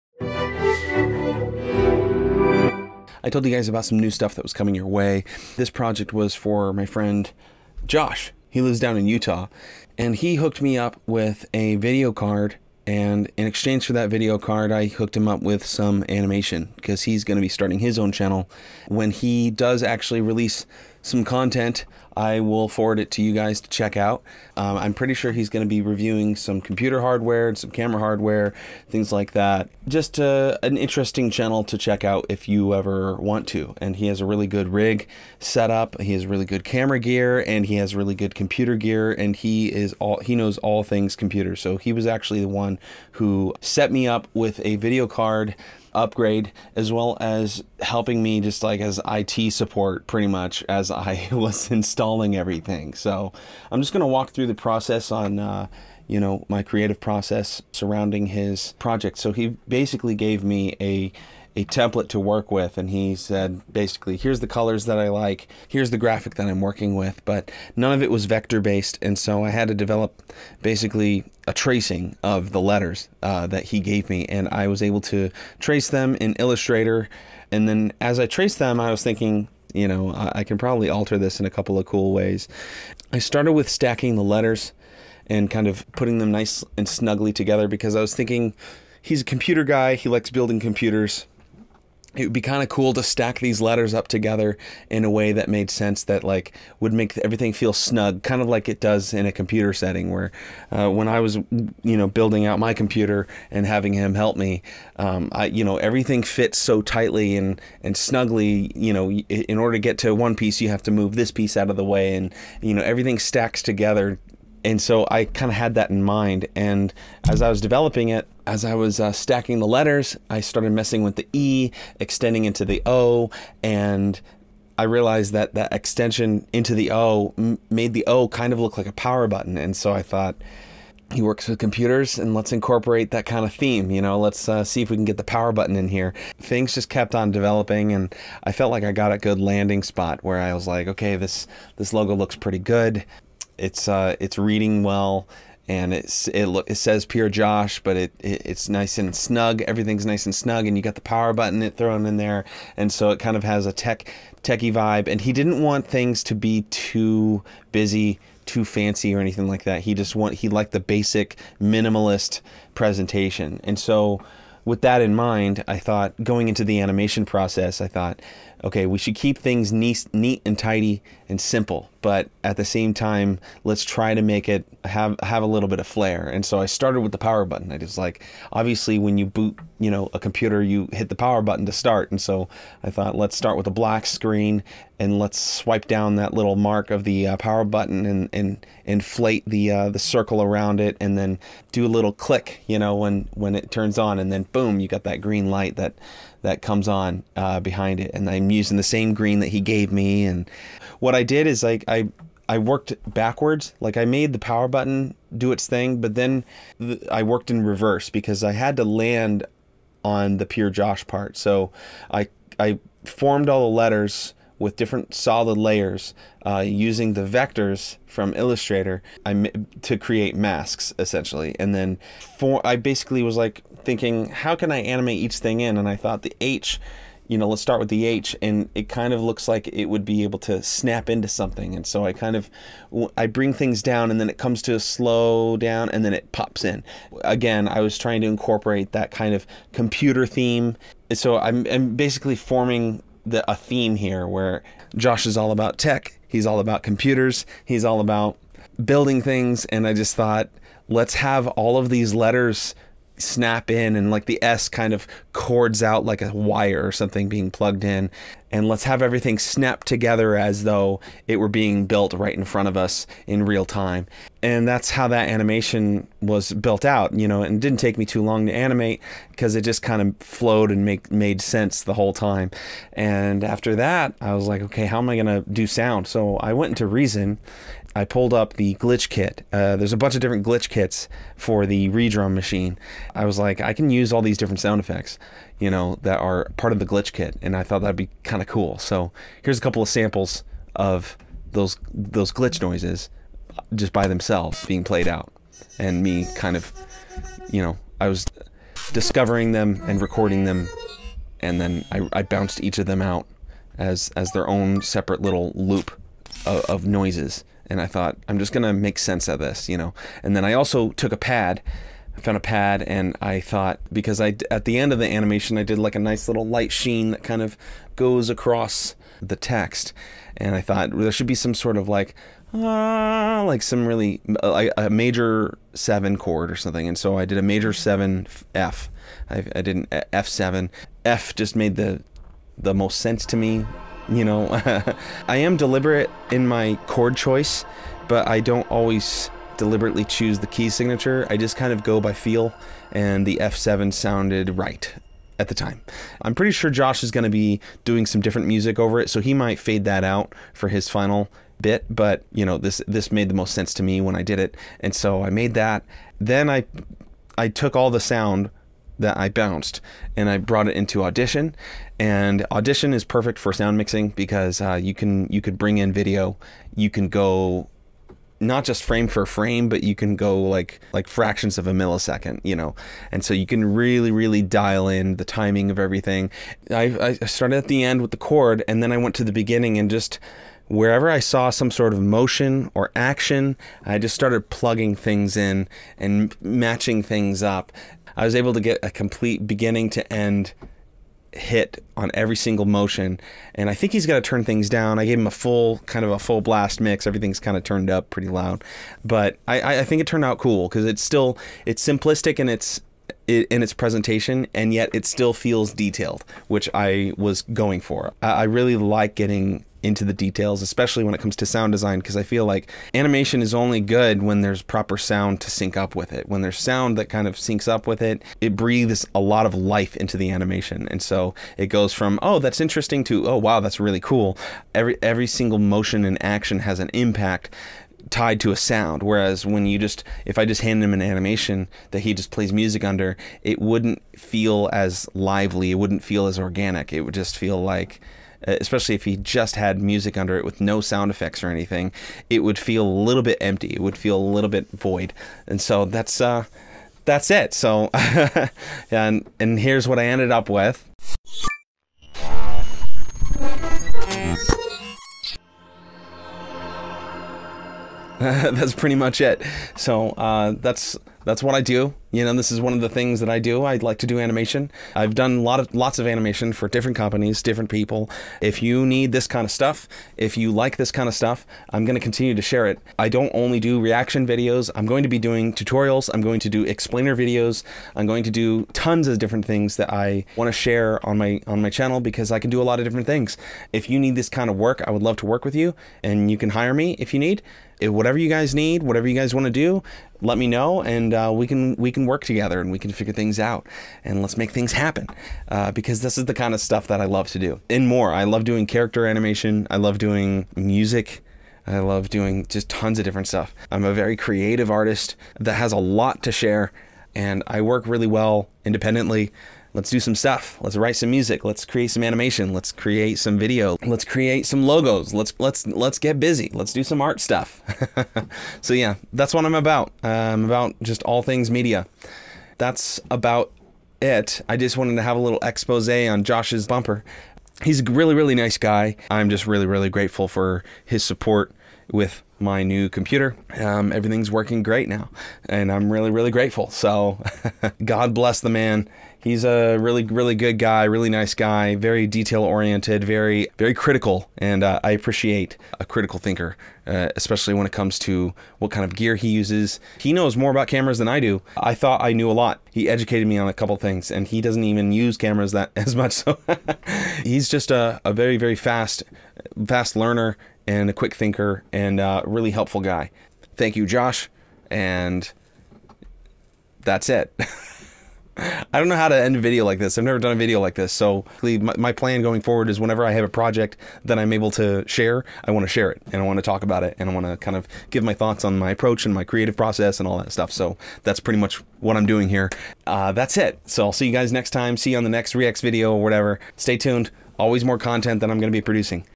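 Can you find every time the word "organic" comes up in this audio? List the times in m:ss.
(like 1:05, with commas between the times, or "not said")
7:16.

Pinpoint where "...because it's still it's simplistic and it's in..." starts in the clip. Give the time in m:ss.
6:40.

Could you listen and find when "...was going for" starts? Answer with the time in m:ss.
6:47.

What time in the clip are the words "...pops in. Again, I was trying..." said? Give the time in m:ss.
3:56.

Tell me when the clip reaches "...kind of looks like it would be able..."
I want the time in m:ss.
3:48.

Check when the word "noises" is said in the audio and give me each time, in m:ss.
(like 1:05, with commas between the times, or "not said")
4:52, 5:06.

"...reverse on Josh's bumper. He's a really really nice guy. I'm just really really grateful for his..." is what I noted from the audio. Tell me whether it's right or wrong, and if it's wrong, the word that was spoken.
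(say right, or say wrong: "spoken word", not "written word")
wrong: "expose", not "reverse".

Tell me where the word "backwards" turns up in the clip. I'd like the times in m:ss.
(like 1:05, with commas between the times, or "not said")
3:23.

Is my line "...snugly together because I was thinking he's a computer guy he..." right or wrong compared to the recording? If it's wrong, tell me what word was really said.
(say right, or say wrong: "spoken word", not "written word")
right.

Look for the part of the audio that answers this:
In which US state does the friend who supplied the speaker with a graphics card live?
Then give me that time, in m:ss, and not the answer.
0:09.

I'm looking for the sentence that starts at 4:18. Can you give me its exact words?
And let's have everything snap together as though it were being built right in front of us in real time.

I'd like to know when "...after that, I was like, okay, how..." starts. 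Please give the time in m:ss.
4:33.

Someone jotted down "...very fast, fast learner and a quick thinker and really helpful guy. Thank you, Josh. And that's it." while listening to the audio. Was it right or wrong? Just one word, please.
right.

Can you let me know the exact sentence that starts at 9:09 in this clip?
He knows more about cameras than I do.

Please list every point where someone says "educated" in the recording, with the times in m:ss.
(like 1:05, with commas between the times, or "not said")
9:12.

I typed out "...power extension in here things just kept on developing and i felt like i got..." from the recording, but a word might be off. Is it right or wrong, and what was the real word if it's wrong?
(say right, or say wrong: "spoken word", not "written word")
wrong: "button", not "extension".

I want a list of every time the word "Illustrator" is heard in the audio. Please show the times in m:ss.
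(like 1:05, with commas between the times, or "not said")
1:16, 3:38.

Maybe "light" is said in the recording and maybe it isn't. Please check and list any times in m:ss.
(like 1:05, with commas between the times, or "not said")
3:15, 5:16.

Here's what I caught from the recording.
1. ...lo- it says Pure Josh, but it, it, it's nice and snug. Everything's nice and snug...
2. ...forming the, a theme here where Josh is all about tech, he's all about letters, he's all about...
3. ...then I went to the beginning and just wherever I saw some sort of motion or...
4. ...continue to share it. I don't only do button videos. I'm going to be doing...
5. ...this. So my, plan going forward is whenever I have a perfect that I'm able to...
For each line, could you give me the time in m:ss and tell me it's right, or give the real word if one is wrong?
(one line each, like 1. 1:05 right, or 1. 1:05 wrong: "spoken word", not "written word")
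1. 2:26 right
2. 4:02 wrong: "computers", not "letters"
3. 6:18 right
4. 7:51 wrong: "reaction", not "button"
5. 9:30 wrong: "project", not "perfect".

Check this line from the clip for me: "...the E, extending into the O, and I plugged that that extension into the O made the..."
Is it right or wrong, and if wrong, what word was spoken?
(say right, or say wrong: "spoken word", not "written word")
wrong: "realized", not "plugged".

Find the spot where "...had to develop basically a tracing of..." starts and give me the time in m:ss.
1:09.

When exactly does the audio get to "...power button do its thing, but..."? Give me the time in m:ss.
3:24.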